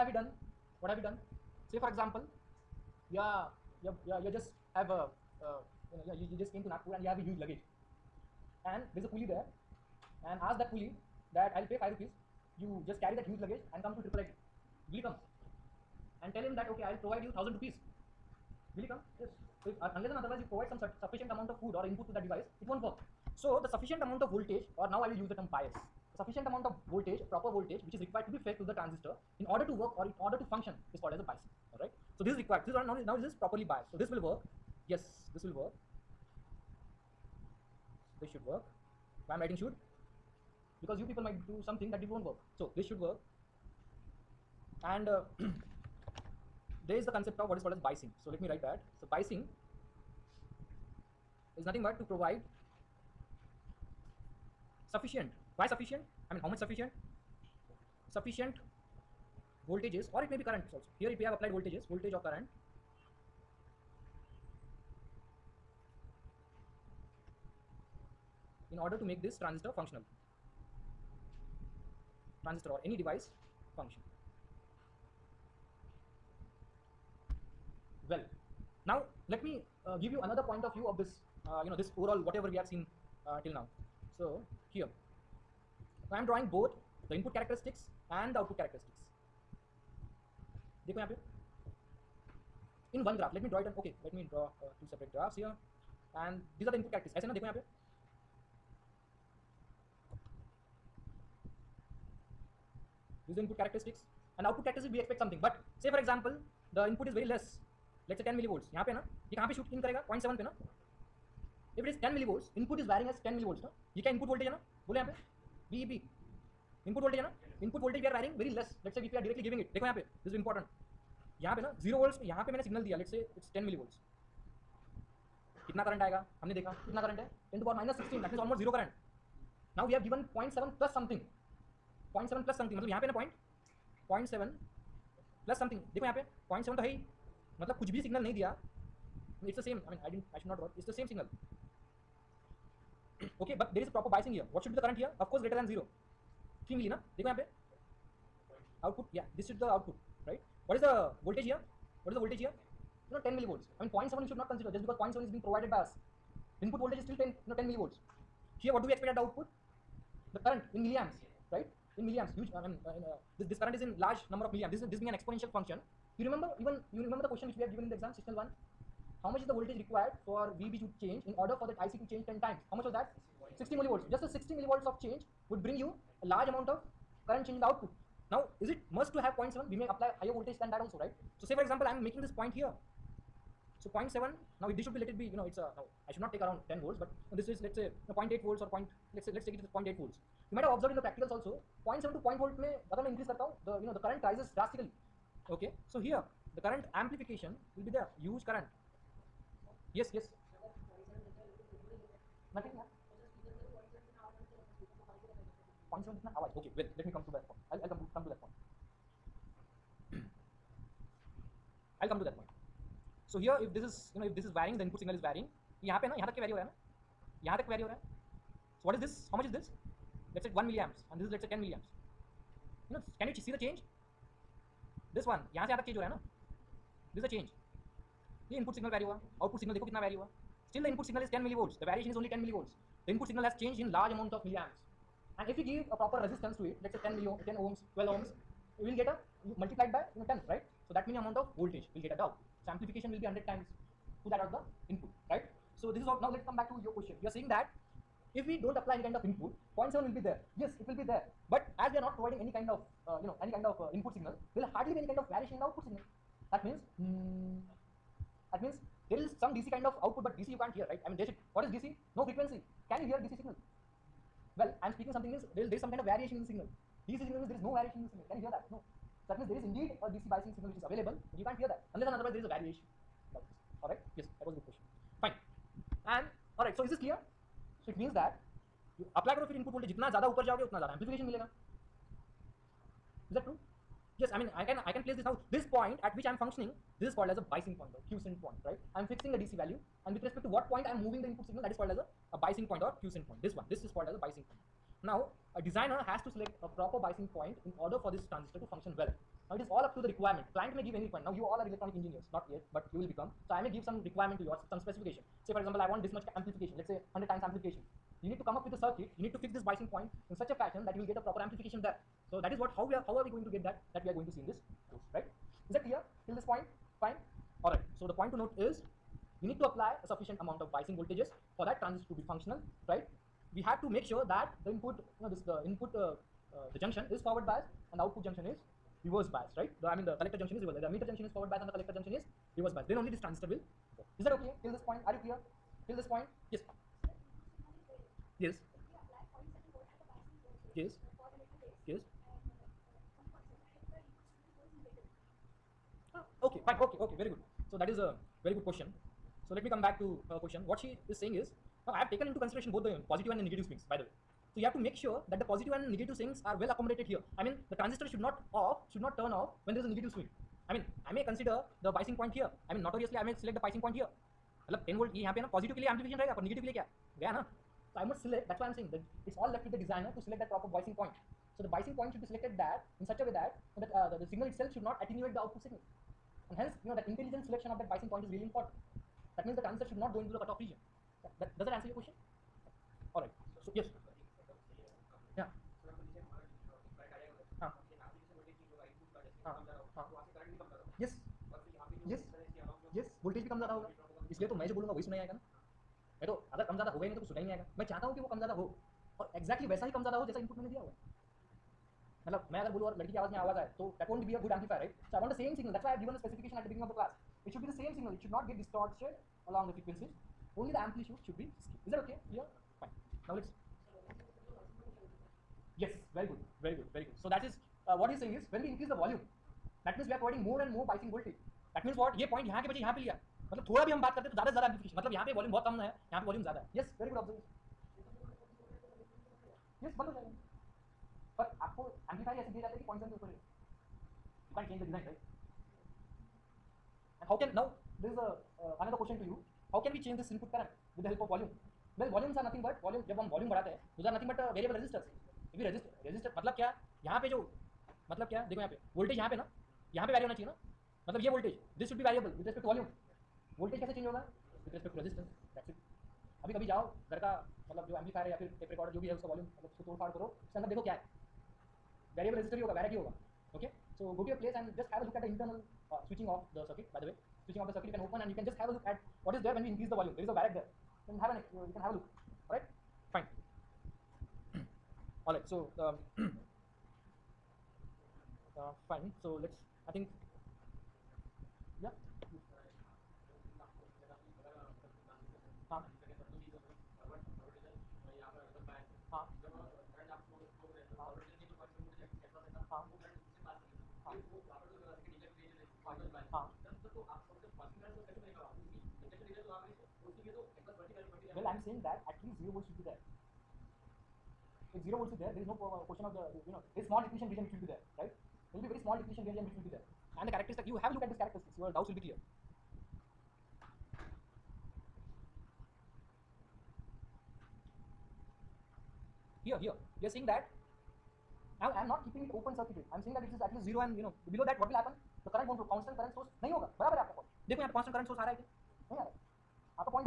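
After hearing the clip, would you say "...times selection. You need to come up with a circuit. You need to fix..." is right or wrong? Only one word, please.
wrong.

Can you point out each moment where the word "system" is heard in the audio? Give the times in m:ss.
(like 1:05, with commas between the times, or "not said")
2:48.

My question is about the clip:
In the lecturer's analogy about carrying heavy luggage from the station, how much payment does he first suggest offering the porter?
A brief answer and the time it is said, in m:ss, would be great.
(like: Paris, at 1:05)
5 rupees, at 0:11.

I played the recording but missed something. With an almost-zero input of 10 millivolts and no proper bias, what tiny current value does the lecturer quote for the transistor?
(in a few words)
10^-16.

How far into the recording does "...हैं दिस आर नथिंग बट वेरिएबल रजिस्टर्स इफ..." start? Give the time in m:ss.
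7:23.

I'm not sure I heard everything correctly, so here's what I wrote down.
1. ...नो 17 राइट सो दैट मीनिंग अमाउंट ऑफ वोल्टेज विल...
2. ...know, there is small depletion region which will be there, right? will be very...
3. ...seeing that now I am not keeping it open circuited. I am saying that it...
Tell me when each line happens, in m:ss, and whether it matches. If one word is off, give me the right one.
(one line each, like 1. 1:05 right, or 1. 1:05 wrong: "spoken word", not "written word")
1. 4:00 wrong: "10", not "17"
2. 8:26 right
3. 8:40 right.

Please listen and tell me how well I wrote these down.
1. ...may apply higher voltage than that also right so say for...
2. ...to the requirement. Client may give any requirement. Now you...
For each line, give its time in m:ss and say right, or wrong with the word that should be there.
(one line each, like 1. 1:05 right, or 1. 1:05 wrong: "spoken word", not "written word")
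1. 2:59 right
2. 4:59 right.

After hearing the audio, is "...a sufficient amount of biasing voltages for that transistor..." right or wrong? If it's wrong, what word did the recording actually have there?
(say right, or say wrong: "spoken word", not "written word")
right.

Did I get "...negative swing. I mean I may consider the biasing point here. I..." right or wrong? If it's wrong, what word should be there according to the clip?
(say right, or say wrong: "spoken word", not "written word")
right.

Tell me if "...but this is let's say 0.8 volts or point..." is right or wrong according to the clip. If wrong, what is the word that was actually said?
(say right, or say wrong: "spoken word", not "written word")
right.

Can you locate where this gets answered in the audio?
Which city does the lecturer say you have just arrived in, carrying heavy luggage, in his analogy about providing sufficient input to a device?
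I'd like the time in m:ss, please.
0:06.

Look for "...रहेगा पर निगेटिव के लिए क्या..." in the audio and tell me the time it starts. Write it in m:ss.
6:06.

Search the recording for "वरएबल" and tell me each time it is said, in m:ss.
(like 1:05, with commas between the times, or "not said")
7:24, 7:32, 7:42.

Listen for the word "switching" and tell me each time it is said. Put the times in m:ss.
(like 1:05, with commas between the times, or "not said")
7:47.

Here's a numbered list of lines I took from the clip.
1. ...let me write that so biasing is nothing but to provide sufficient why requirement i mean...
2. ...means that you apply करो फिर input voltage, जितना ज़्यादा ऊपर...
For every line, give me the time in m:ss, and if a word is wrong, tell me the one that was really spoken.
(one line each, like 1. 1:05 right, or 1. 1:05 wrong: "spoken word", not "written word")
1. 0:48 wrong: "sufficient", not "requirement"
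2. 4:38 right.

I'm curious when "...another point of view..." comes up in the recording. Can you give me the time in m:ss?
1:20.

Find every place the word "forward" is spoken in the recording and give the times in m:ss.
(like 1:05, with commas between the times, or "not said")
5:27, 5:31.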